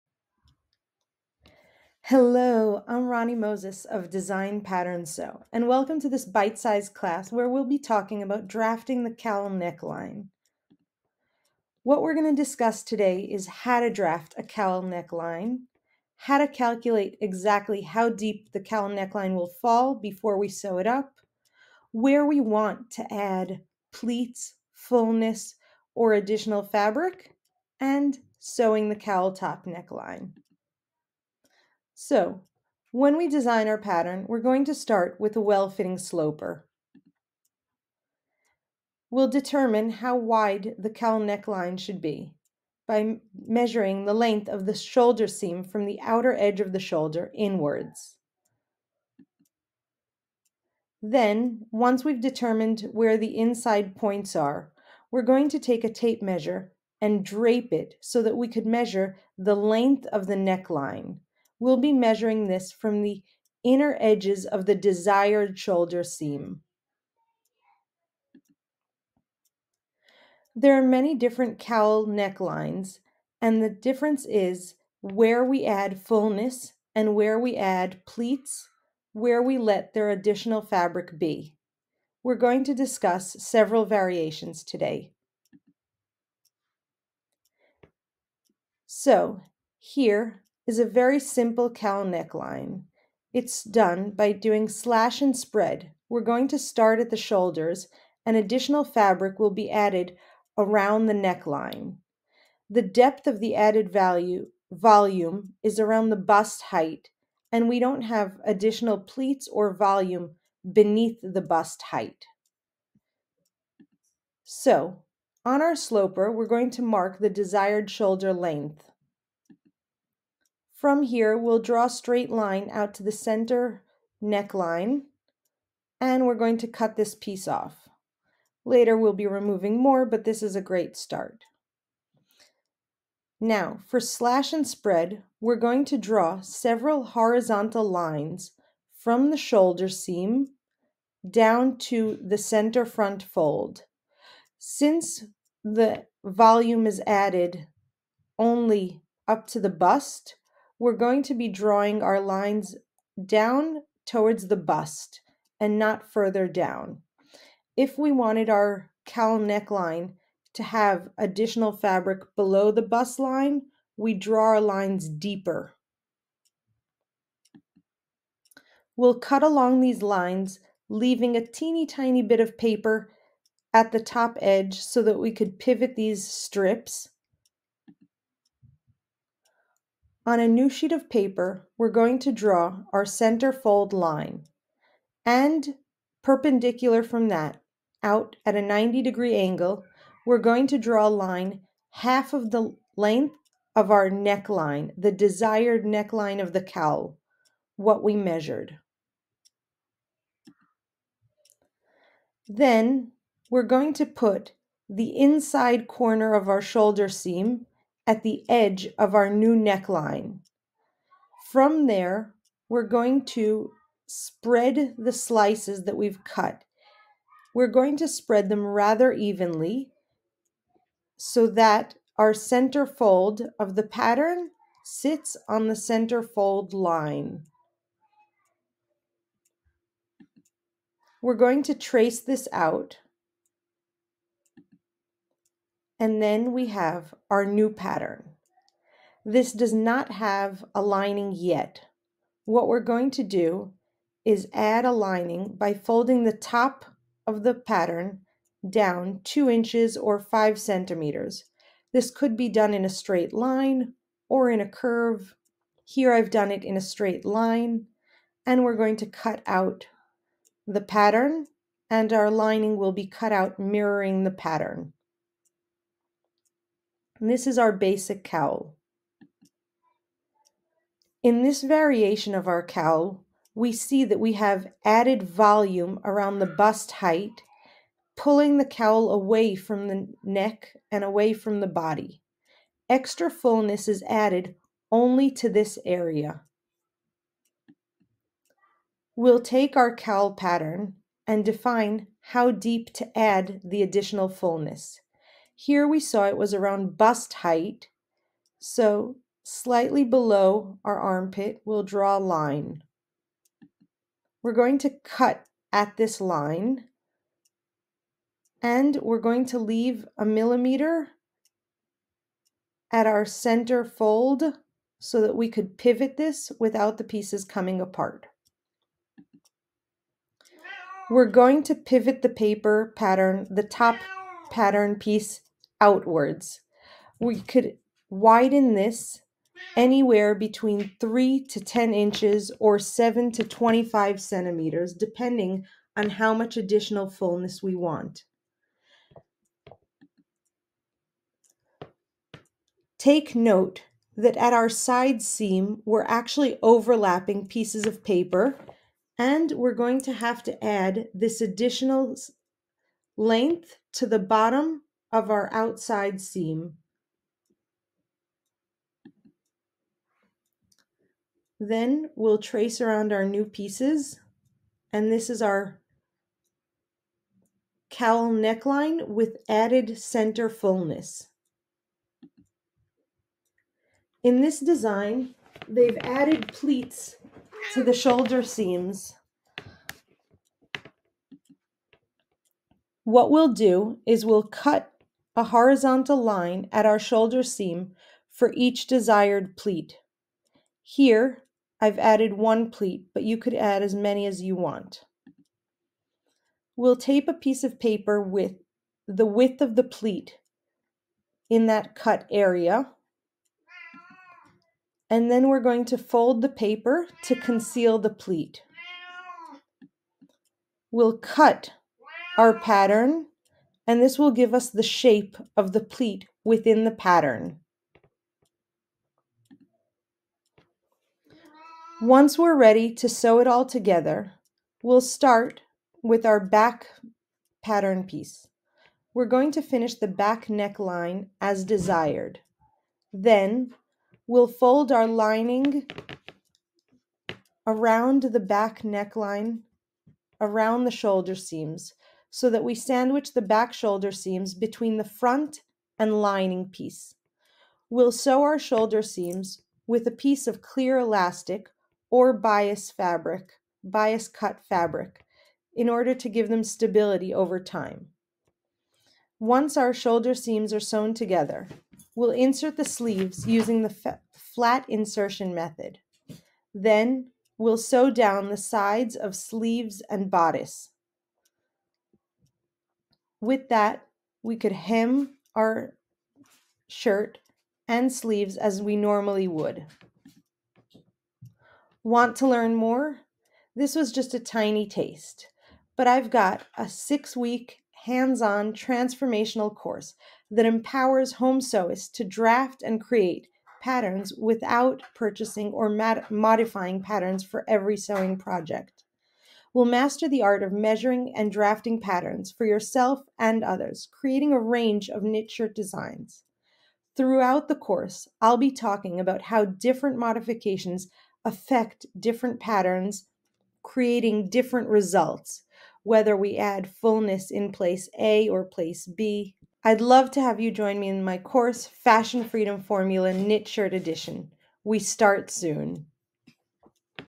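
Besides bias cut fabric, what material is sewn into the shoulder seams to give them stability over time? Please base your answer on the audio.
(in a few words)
Clear elastic.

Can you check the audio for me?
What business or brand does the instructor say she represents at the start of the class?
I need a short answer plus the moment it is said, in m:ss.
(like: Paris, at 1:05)
Design Pattern Sew, at 0:04.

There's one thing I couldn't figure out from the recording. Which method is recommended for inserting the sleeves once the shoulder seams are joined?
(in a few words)
Flat insertion method.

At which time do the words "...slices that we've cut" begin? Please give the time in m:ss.
3:35.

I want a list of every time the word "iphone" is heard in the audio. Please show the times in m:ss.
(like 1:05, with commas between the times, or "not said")
not said.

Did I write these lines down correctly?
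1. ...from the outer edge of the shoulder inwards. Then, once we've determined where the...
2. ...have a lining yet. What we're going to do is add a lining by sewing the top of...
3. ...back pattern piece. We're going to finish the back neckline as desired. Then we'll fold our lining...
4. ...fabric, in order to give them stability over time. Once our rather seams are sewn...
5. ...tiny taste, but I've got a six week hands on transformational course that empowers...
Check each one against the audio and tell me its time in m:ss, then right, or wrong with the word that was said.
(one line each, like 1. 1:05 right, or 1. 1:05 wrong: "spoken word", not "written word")
1. 0:45 right
2. 4:00 wrong: "folding", not "sewing"
3. 7:06 right
4. 7:34 wrong: "shoulder", not "rather"
5. 8:04 right.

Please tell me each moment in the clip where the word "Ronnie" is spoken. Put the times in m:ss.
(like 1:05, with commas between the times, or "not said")
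0:03.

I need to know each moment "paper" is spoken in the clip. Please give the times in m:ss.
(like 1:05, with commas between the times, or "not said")
2:52, 3:01, 5:22, 5:48, 6:37, 6:46.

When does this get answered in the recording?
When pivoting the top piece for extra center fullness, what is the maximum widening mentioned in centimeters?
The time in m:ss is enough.
5:33.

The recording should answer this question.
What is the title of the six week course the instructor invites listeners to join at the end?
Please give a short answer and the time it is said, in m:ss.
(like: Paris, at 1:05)
Fashion Freedom Formula Knit Shirt Edition, at 8:41.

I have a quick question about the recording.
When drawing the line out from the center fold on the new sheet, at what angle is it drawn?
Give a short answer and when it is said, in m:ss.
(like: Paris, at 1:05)
90 degrees, at 3:08.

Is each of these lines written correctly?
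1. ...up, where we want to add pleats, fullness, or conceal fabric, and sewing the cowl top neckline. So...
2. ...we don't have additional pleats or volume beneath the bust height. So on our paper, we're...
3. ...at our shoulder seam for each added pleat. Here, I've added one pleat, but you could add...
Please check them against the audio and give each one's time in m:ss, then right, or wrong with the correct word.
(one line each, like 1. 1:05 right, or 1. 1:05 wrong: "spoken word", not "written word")
1. 0:20 wrong: "additional", not "conceal"
2. 1:47 wrong: "sloper", not "paper"
3. 6:26 wrong: "desired", not "added".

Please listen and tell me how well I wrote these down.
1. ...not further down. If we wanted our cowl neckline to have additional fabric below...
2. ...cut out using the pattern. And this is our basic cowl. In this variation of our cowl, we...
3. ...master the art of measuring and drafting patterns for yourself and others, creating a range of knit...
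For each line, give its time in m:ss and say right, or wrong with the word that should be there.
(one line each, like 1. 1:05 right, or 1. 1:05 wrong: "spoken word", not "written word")
1. 2:35 right
2. 4:23 wrong: "mirroring", not "using"
3. 8:19 right.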